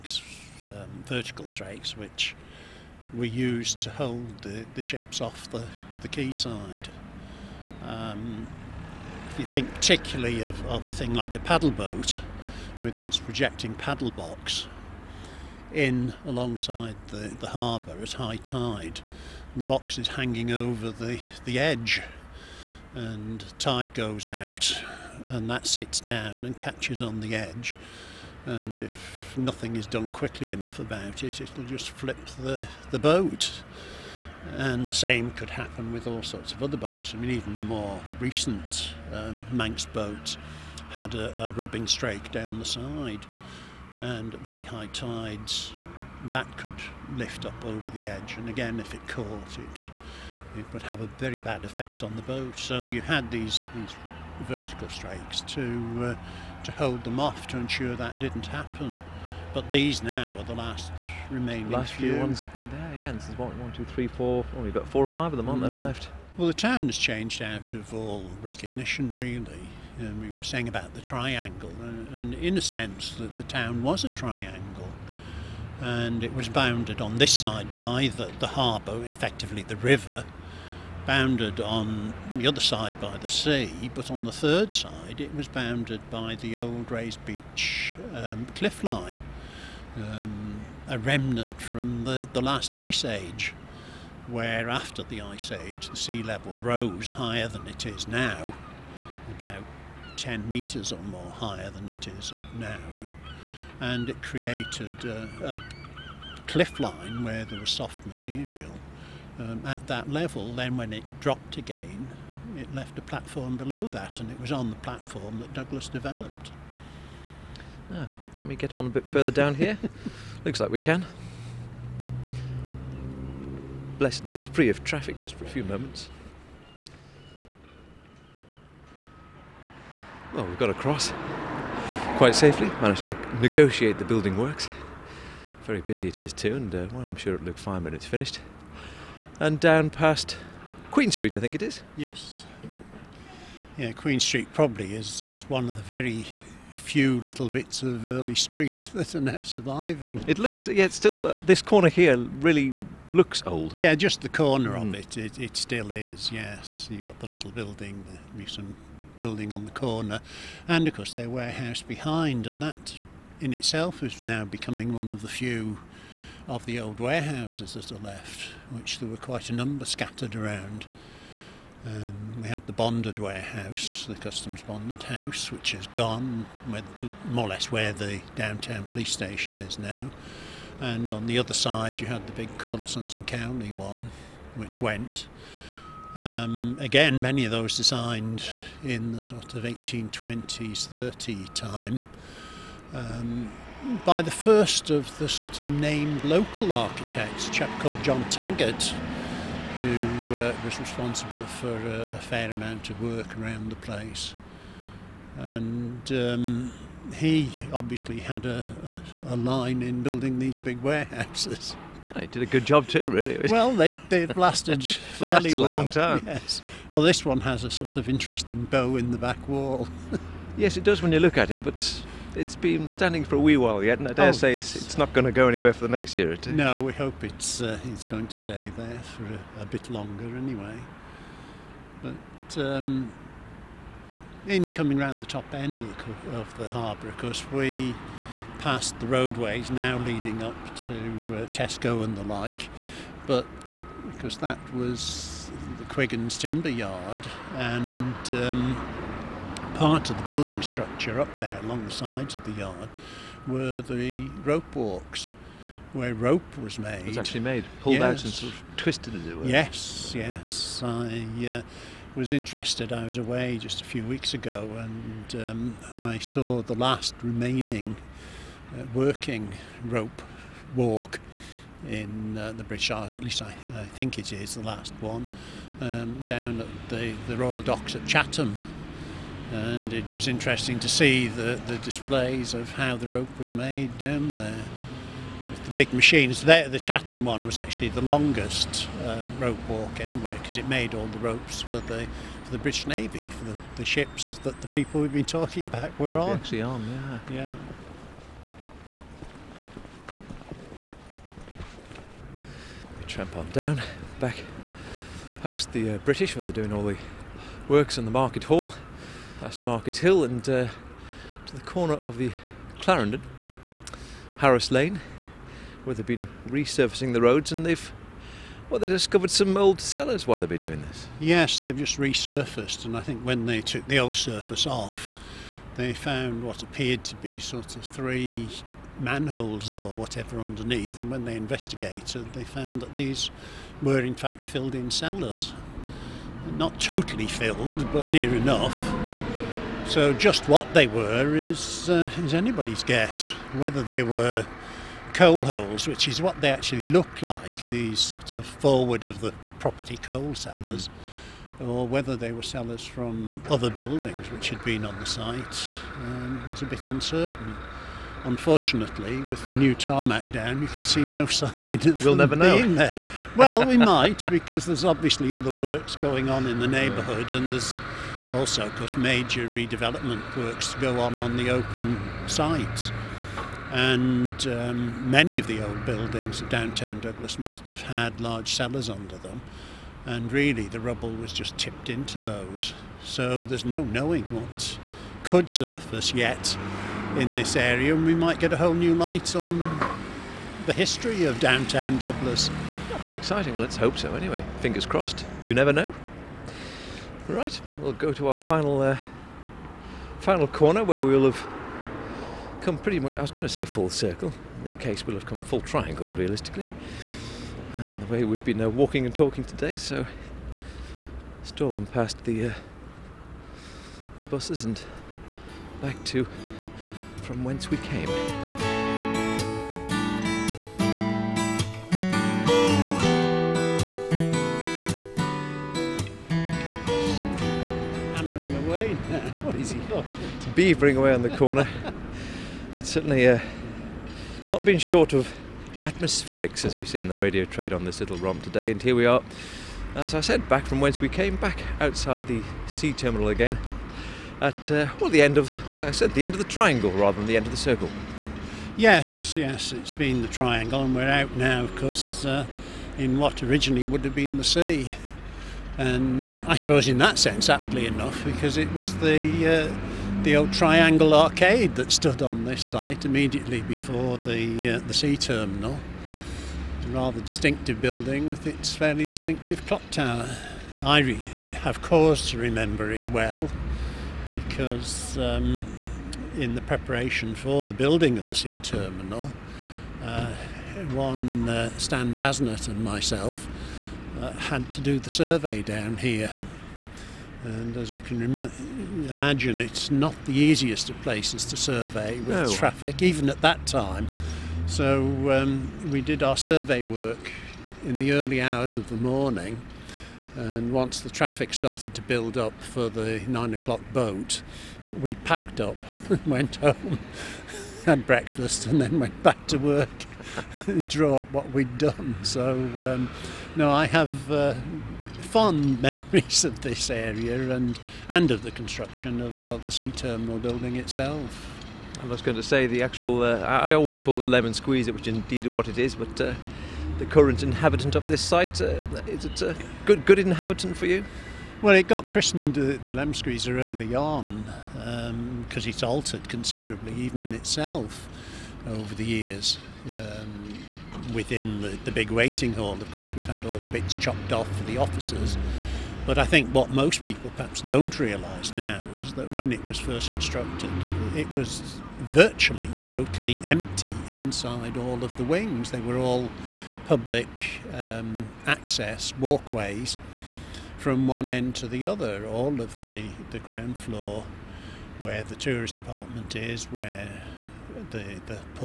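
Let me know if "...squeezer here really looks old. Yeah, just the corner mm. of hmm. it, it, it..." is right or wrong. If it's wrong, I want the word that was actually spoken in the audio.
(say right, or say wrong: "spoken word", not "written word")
wrong: "corner", not "squeezer".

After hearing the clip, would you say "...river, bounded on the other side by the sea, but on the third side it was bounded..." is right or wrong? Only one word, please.
right.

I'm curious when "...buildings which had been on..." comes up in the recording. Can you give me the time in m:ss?
5:53.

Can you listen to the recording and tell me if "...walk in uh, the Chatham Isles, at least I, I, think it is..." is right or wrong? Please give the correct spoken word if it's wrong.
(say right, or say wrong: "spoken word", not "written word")
wrong: "British", not "Chatham".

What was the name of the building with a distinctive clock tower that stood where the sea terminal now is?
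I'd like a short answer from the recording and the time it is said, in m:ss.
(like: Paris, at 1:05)
Triangle arcade, at 7:40.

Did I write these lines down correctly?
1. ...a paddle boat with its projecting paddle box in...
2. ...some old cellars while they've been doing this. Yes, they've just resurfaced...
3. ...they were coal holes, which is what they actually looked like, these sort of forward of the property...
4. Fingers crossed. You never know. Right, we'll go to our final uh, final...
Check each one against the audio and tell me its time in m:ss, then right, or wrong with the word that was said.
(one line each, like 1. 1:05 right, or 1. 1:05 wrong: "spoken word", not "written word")
1. 0:11 right
2. 5:19 right
3. 5:43 right
4. 6:34 right.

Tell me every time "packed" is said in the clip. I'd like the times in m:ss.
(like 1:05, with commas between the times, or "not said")
8:25.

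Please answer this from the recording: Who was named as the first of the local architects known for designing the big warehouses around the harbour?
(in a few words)
John Taggart.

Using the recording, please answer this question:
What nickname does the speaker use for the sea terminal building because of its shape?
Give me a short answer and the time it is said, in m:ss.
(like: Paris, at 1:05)
Lemon squeezer, at 8:44.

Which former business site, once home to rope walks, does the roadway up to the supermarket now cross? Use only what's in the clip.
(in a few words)
Quiggins Timber Yard.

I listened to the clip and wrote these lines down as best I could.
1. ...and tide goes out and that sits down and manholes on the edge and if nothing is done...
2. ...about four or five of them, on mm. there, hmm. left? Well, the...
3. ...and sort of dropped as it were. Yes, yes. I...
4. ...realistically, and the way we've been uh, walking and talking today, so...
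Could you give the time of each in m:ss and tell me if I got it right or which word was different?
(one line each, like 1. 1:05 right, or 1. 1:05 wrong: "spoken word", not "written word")
1. 0:22 wrong: "catches", not "manholes"
2. 1:04 right
3. 4:18 wrong: "twisted", not "dropped"
4. 6:46 right.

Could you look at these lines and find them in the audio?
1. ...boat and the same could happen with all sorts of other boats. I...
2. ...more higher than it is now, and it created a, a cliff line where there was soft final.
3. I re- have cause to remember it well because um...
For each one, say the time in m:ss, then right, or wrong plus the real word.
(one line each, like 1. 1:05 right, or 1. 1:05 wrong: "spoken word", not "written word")
1. 0:32 right
2. 1:41 wrong: "material", not "final"
3. 7:50 right.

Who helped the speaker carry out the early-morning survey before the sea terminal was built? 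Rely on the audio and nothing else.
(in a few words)
Stan Basnett.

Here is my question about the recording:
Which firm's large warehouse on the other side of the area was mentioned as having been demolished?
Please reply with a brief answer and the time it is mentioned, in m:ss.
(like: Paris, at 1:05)
Corlett Sons and Cowley, at 3:02.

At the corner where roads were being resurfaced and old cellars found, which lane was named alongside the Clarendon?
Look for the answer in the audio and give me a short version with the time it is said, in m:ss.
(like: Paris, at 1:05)
Harris Lane, at 5:14.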